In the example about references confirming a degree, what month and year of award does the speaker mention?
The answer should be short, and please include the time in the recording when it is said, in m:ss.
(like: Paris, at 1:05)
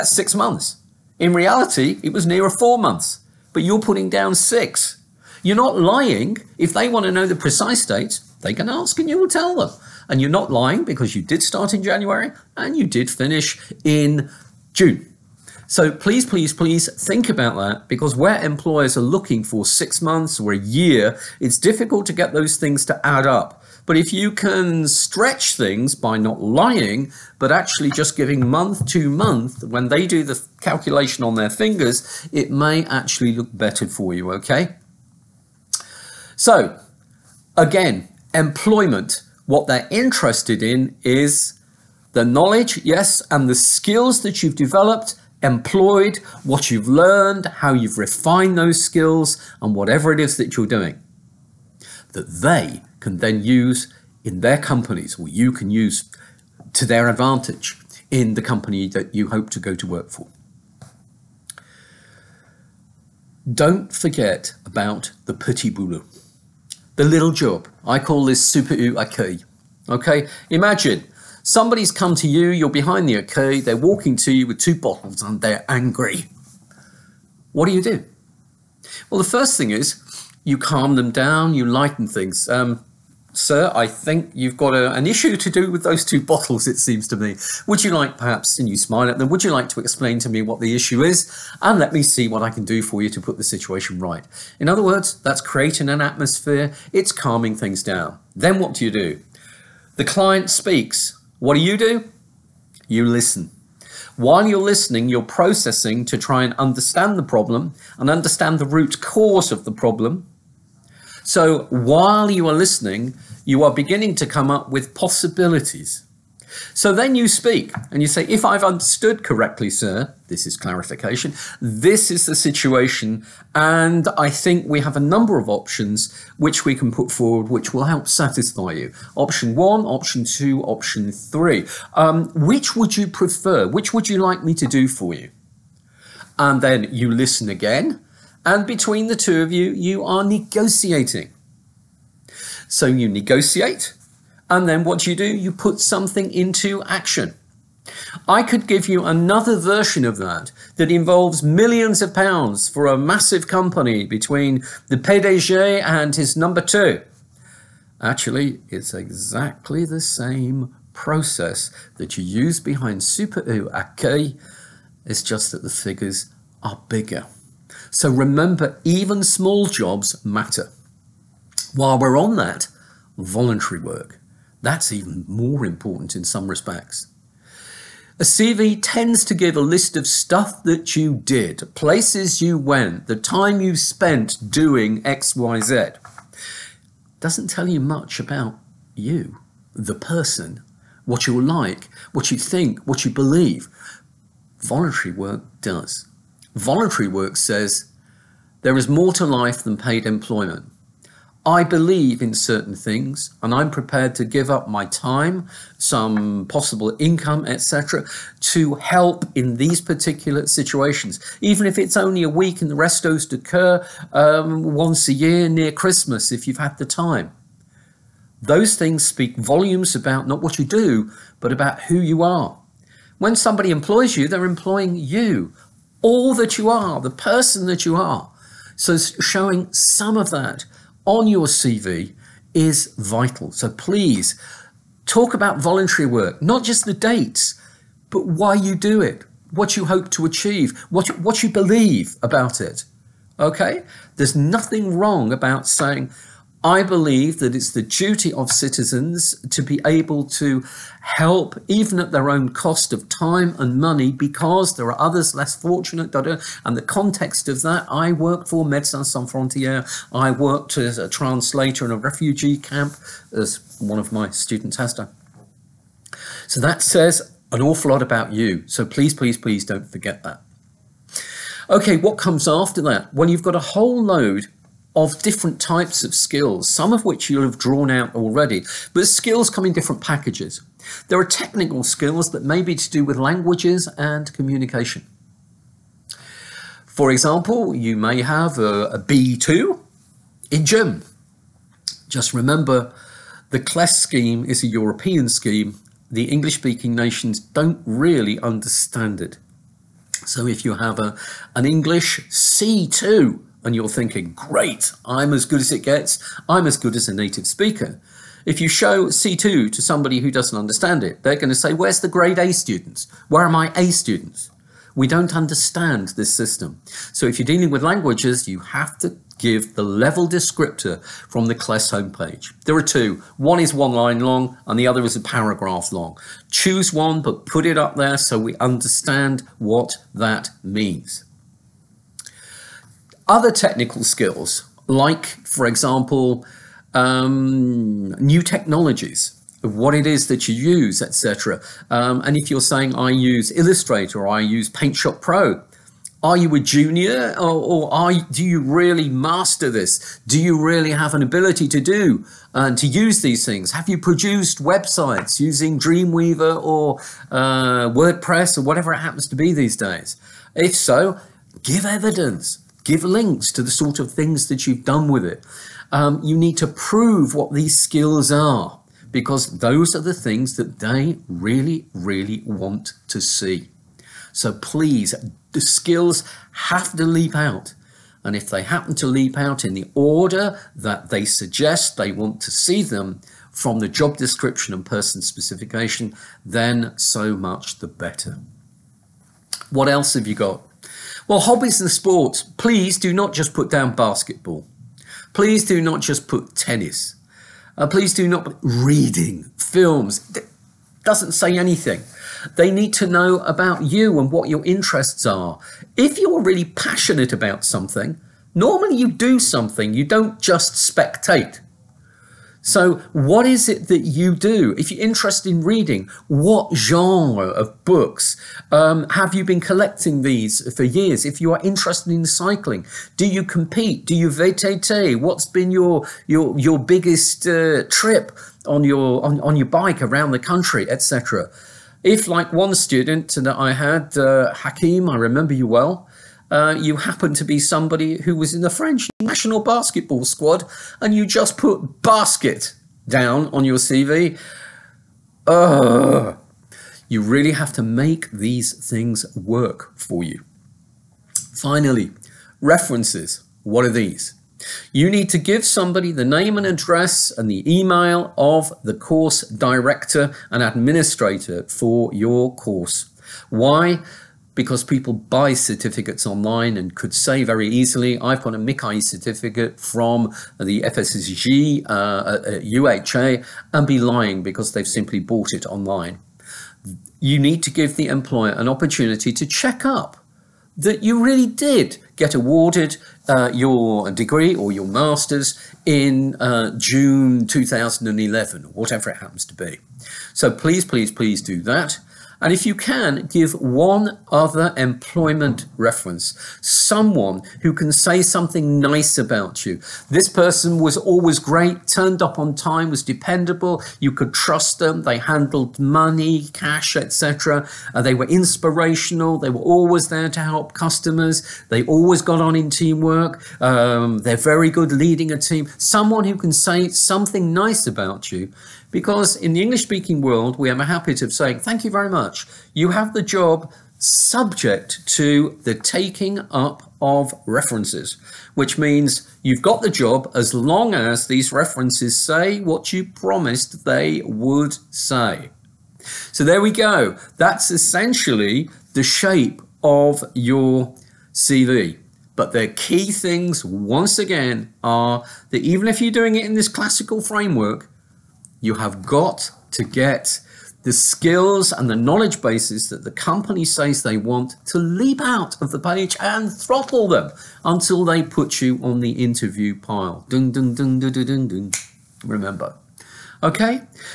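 June 2011, at 8:06.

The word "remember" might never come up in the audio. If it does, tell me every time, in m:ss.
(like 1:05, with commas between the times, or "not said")
2:48, 4:52, 7:15, 9:22.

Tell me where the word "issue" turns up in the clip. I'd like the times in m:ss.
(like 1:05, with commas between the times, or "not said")
1:25, 1:30.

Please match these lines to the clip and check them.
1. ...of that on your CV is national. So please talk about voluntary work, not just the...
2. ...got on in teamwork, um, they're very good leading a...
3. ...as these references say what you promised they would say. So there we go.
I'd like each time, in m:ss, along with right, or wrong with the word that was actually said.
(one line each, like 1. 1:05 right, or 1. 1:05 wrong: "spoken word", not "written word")
1. 3:50 wrong: "vital", not "national"
2. 8:32 right
3. 8:50 right.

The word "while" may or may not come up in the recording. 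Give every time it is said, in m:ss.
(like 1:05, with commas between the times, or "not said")
1:44, 1:51, 2:51.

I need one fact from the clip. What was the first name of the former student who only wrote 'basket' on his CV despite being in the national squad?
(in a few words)
Hakim.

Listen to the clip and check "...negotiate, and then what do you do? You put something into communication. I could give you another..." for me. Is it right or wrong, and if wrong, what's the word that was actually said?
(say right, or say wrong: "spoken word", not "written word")
wrong: "action", not "communication".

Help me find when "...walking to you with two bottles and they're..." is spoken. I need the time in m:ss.
1:13.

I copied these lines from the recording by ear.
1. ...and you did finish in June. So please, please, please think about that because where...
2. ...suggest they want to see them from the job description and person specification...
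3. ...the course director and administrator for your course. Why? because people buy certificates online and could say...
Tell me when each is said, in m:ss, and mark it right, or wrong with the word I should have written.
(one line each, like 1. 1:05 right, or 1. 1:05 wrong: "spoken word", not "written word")
1. 0:12 right
2. 6:21 right
3. 7:38 right.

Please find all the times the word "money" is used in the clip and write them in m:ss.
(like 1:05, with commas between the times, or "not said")
4:13, 8:25.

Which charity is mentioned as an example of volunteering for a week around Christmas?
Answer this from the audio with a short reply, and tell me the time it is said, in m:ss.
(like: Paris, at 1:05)
Restos du Cœur, at 3:32.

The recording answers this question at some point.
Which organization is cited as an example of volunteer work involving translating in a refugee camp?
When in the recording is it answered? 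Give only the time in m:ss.
4:18.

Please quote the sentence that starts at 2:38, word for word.
Actually, it's exactly the same process that you use behind Super U accueil.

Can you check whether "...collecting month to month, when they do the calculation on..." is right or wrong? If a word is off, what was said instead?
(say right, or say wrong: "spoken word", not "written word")
wrong: "giving", not "collecting".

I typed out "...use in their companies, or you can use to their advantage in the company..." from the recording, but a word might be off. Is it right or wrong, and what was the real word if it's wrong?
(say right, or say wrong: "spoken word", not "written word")
right.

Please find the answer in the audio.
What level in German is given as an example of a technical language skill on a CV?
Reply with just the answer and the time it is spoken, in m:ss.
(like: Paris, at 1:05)
B2, at 4:48.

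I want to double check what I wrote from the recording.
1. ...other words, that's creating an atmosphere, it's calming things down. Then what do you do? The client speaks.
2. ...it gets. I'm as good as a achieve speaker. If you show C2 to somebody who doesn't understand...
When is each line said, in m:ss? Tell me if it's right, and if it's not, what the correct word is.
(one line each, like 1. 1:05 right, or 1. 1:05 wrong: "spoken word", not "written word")
1. 1:34 right
2. 5:05 wrong: "native", not "achieve".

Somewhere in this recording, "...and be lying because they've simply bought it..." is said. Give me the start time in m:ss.
7:53.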